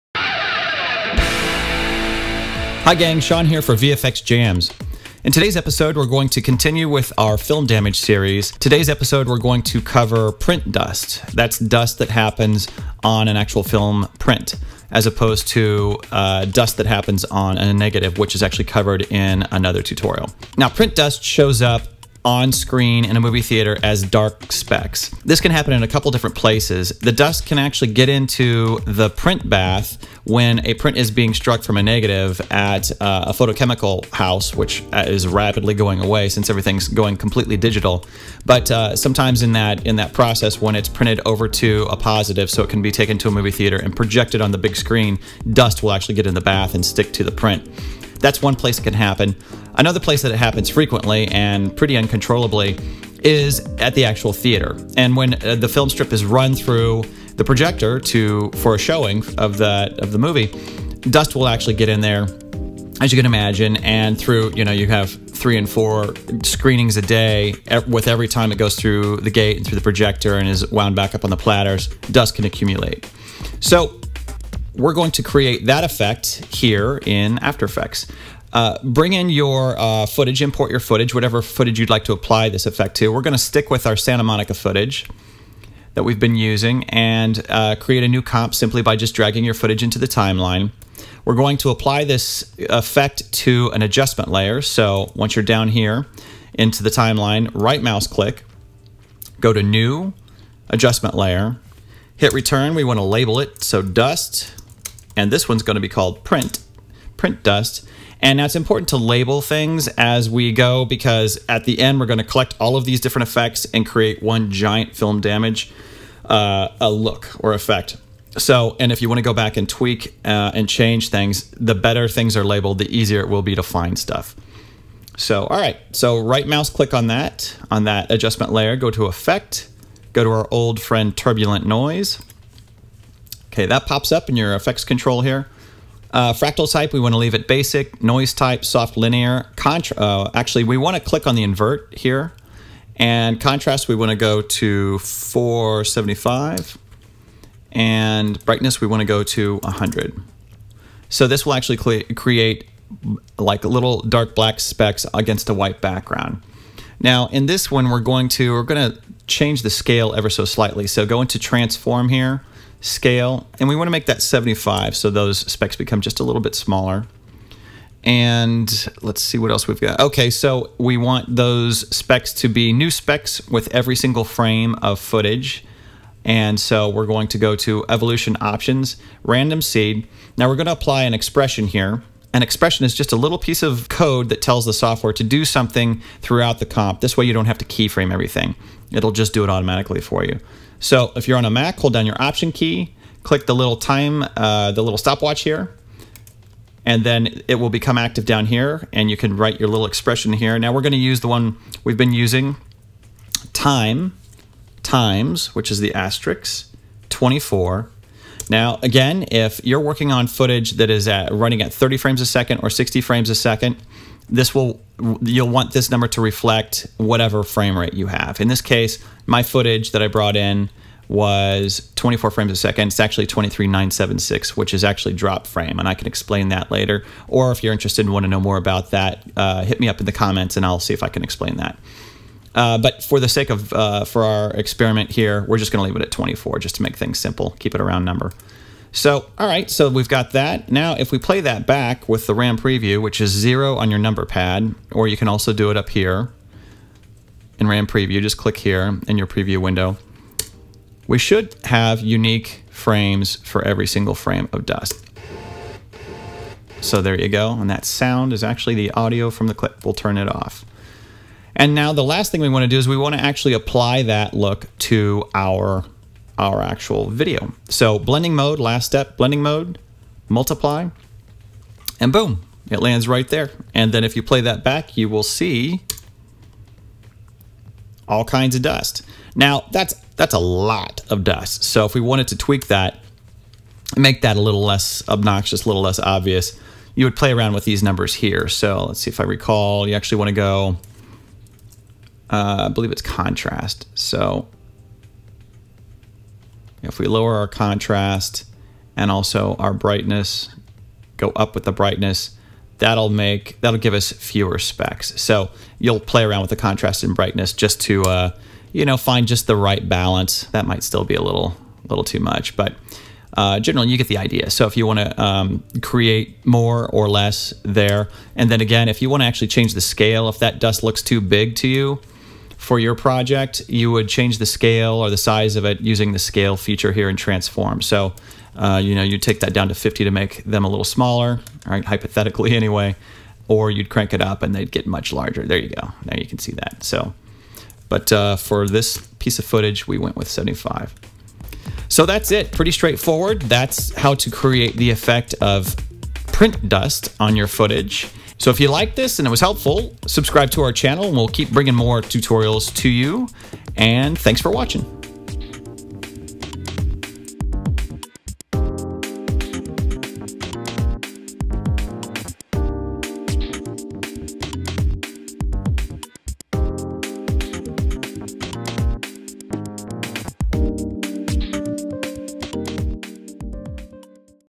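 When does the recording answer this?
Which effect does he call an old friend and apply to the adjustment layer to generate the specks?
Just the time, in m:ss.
2:11.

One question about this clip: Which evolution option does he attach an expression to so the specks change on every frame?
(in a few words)
random seed.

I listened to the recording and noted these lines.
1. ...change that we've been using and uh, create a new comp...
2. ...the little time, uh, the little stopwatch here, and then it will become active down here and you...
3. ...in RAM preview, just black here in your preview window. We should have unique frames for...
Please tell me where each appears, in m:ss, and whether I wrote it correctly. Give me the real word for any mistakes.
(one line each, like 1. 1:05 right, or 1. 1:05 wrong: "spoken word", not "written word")
1. 1:24 wrong: "footage", not "change"
2. 3:13 right
3. 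4:07 wrong: "click", not "black".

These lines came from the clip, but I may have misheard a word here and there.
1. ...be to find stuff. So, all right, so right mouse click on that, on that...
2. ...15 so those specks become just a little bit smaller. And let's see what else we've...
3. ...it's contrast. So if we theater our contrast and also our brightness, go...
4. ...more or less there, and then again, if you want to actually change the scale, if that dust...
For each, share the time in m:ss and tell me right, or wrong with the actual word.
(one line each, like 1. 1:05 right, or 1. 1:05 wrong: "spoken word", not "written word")
1. 2:03 right
2. 2:44 wrong: "75", not "15"
3. 4:52 wrong: "lower", not "theater"
4. 5:16 right.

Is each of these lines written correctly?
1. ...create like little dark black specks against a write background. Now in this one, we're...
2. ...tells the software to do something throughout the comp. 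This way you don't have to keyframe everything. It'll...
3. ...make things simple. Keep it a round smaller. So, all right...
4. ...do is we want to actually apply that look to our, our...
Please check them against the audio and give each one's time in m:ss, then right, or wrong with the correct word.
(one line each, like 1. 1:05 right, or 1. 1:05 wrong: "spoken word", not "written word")
1. 2:32 wrong: "white", not "write"
2. 3:04 right
3. 3:56 wrong: "number", not "smaller"
4. 4:22 right.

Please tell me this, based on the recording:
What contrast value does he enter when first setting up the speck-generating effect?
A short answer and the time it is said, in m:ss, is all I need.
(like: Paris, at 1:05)
475, at 2:24.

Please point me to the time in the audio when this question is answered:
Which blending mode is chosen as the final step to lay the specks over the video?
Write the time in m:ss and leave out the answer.
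4:30.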